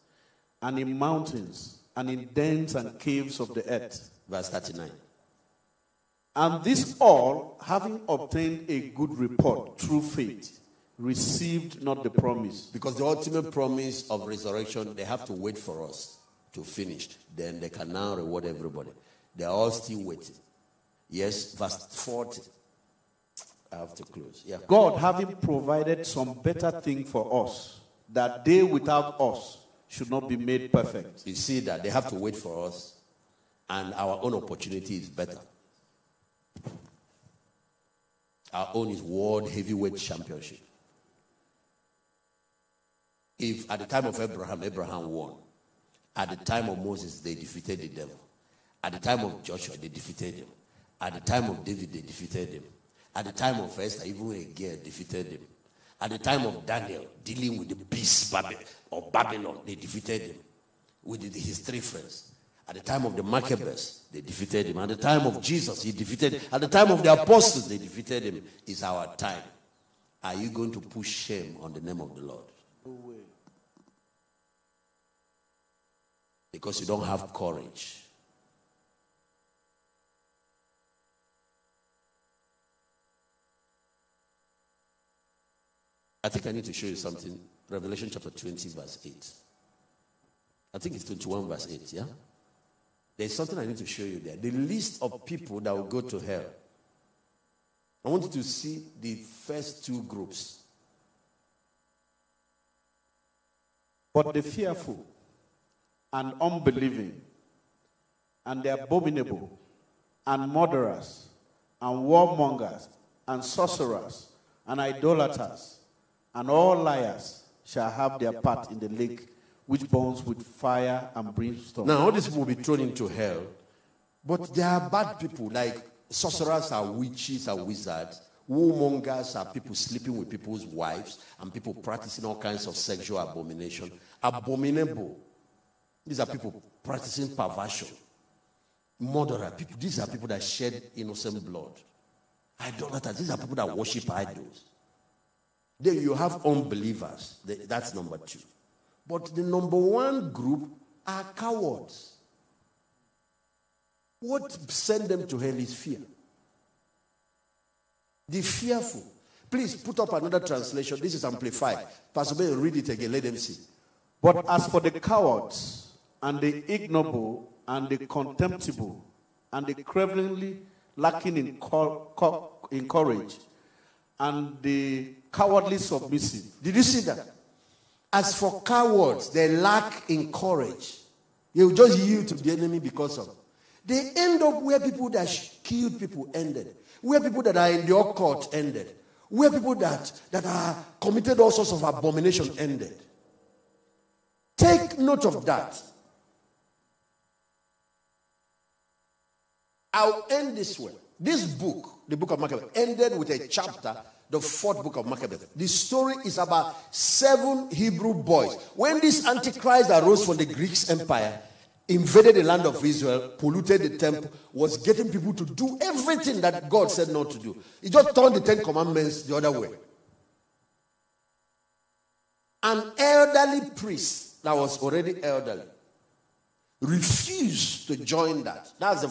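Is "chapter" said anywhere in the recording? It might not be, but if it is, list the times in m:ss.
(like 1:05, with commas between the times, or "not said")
1:28, 3:23.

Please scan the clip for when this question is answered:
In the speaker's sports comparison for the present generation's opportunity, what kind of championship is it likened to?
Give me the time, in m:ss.
0:39.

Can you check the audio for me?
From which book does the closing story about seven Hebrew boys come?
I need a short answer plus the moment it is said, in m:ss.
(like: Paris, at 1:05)
4 Maccabees, at 3:24.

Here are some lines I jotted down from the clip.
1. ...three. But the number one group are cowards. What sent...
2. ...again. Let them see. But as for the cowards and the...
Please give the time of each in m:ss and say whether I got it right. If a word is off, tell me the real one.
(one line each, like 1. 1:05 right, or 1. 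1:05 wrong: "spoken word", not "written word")
1. 2:28 wrong: "two", not "three"
2. 2:42 right.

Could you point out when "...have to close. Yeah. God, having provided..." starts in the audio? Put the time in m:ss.
0:23.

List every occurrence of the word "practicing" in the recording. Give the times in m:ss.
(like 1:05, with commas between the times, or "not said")
2:11, 2:16.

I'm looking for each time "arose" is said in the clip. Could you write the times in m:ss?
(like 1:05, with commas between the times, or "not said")
3:29.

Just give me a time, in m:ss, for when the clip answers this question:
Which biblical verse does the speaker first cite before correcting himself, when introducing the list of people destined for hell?
1:27.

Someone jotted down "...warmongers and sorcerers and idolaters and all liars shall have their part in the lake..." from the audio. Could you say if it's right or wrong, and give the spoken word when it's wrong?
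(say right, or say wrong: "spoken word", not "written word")
right.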